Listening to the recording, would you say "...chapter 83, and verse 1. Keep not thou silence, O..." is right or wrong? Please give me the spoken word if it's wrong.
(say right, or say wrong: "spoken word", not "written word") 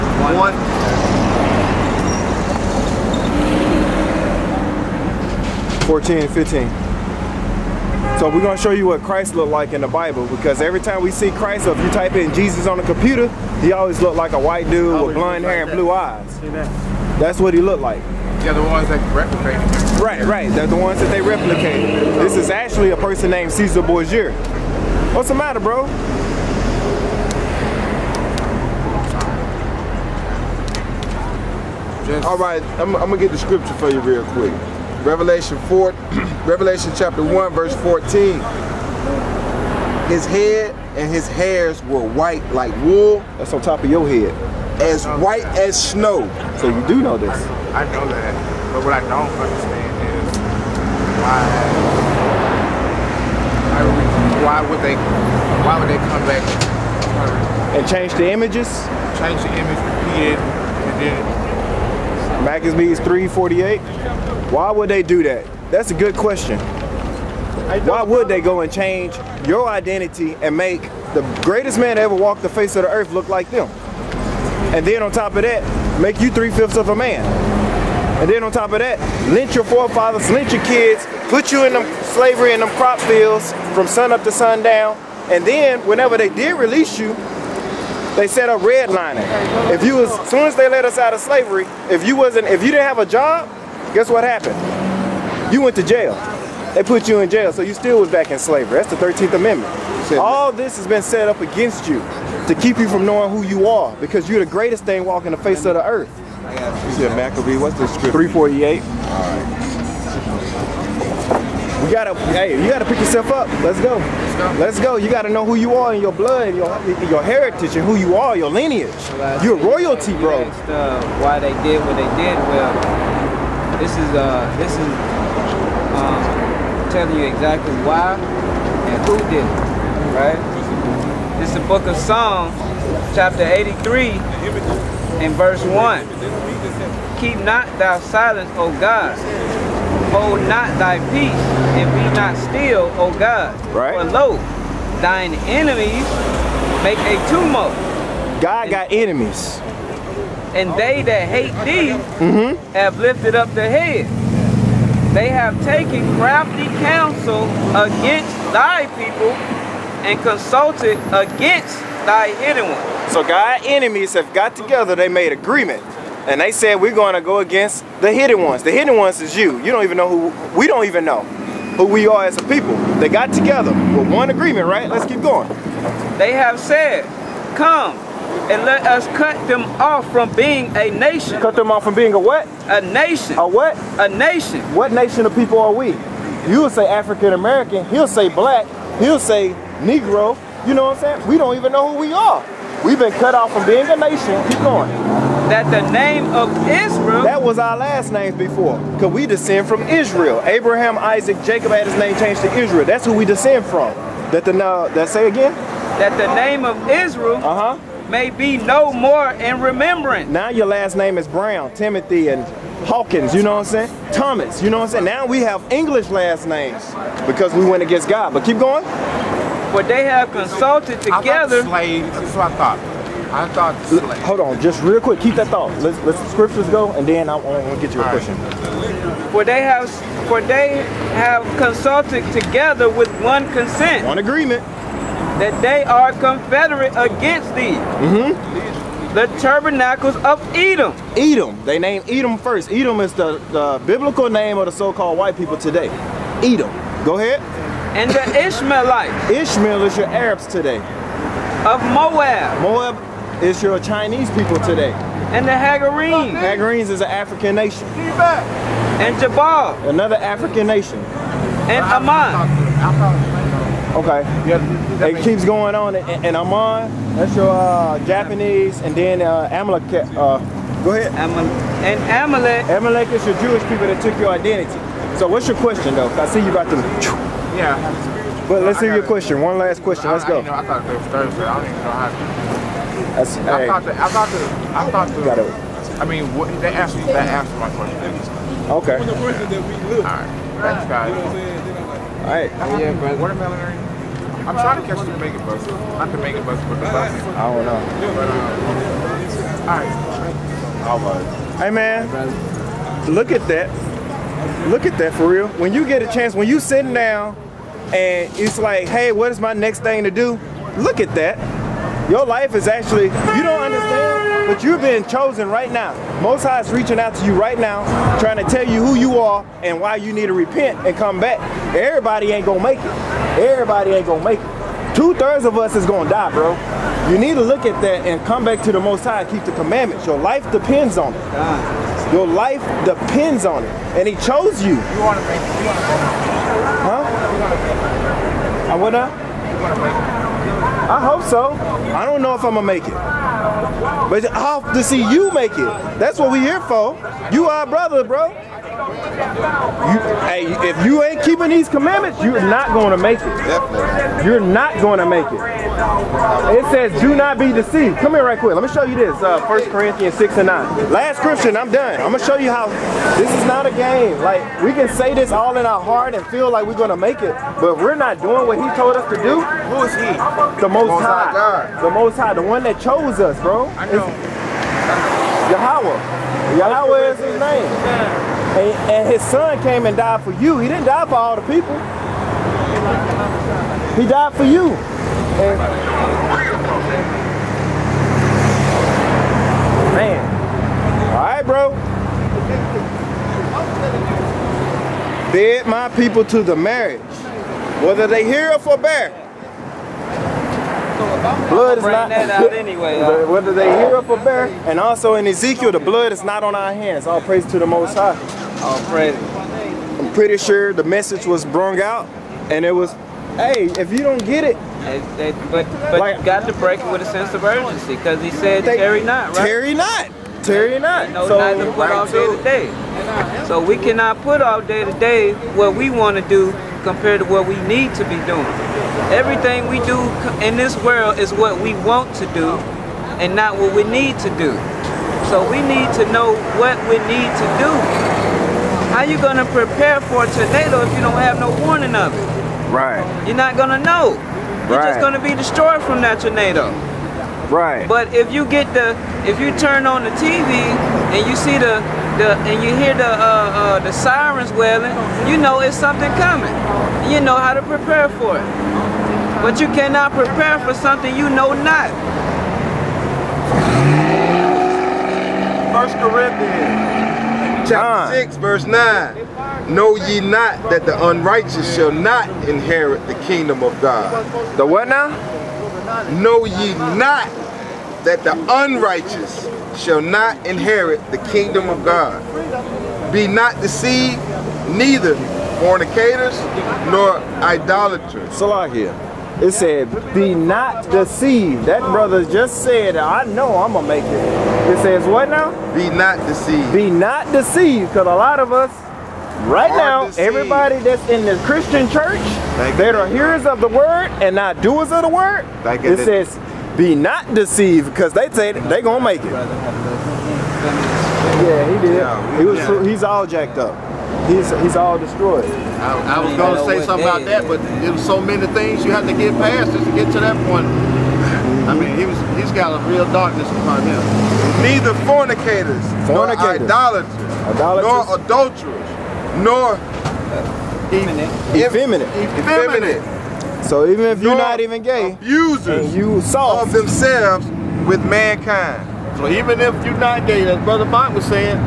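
right.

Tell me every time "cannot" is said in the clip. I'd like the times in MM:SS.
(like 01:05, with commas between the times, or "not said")
07:03, 07:39.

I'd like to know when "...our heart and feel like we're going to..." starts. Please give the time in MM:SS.
06:05.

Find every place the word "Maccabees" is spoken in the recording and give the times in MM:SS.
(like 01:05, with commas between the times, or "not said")
01:02, 01:47.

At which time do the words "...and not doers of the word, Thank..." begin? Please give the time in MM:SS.
08:24.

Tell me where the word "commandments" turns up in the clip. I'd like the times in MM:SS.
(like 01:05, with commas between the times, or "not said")
05:29, 05:51.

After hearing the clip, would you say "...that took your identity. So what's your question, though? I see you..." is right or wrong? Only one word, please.
right.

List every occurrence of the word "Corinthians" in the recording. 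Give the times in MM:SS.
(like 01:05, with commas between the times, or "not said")
05:59, 07:45.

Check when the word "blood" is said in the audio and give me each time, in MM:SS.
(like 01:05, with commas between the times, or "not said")
01:56, 06:40, 06:45.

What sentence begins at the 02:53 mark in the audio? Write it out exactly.
They got together with one agreement, right?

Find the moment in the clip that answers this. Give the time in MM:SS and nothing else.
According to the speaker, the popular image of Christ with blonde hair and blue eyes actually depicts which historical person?
00:23.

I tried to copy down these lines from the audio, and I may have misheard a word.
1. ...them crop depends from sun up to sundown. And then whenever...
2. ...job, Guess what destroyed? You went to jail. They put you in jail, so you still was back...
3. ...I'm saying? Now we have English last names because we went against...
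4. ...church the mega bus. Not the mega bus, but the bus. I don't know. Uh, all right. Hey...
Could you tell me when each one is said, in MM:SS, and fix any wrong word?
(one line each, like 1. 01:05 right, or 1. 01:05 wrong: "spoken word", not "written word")
1. 01:22 wrong: "fields", not "depends"
2. 01:33 wrong: "happened", not "destroyed"
3. 03:34 right
4. 04:54 wrong: "catch", not "church".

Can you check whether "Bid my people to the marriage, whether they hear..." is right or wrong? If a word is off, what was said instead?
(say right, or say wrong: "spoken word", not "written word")
right.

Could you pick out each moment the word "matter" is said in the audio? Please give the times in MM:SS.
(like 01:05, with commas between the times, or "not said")
00:25.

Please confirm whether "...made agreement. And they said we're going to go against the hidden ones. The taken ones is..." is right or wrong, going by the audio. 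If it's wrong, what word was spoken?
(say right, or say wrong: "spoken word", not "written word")
wrong: "hidden", not "taken".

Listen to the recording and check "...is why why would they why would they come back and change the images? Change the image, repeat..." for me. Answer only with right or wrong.
right.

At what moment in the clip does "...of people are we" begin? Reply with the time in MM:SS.
03:05.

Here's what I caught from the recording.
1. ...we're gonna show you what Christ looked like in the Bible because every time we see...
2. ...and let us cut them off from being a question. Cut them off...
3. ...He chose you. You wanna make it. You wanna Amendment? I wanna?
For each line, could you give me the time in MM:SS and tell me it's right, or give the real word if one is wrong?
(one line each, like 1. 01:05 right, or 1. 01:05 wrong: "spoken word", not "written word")
1. 00:08 right
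2. 02:58 wrong: "nation", not "question"
3. 05:34 wrong: "Huh", not "Amendment".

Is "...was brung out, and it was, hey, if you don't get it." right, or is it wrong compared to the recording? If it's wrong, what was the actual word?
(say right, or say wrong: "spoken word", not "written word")
right.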